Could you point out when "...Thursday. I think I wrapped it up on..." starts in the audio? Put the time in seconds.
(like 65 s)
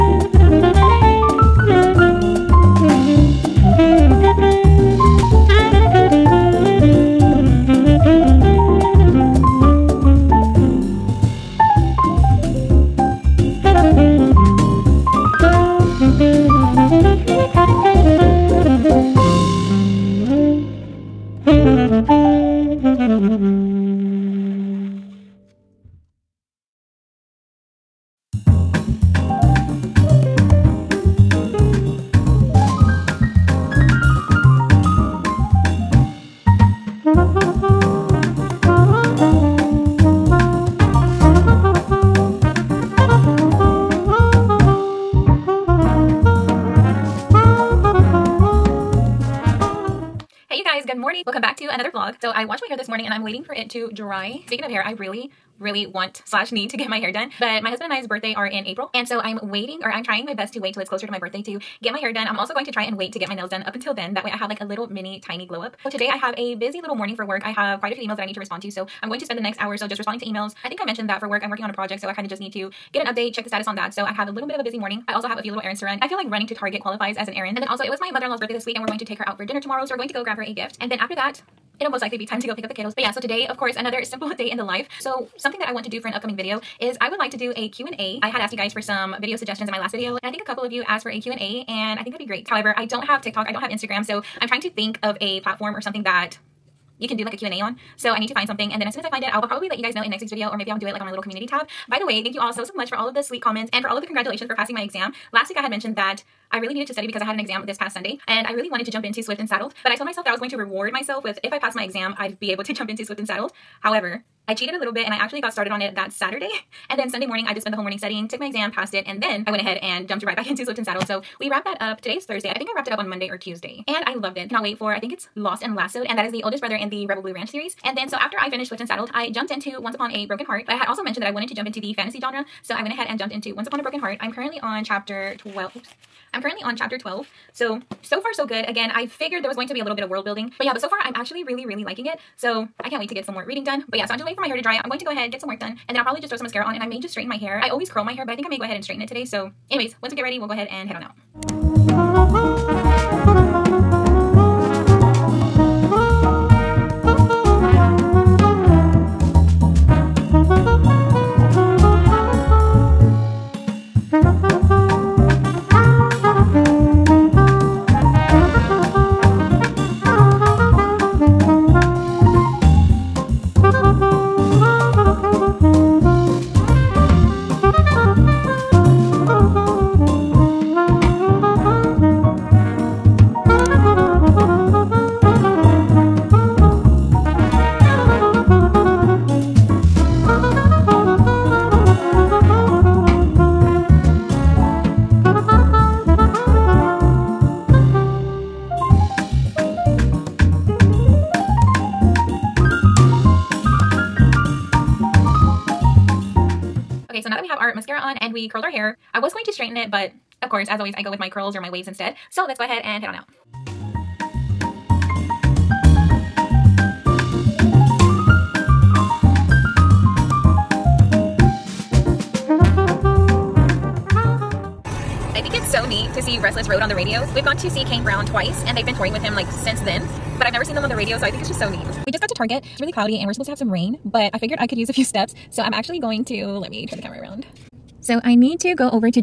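122 s.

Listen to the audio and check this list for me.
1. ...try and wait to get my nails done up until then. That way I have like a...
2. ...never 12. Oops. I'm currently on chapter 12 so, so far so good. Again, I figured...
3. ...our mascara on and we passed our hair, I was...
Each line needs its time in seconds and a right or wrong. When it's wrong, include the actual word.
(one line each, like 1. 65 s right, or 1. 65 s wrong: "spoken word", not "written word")
1. 62 s right
2. 134 s wrong: "chapter", not "never"
3. 207 s wrong: "curled", not "passed".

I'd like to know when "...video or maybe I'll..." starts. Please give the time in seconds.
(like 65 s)
100 s.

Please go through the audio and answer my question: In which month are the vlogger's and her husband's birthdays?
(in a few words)
April.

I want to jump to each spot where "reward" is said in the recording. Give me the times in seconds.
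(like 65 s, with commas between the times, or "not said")
110 s.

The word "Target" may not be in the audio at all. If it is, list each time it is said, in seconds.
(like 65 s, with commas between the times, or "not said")
76 s, 232 s.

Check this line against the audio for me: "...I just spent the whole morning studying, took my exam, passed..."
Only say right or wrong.
right.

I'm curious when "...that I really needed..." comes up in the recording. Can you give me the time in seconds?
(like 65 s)
105 s.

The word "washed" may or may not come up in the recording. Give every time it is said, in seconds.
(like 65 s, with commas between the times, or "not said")
52 s.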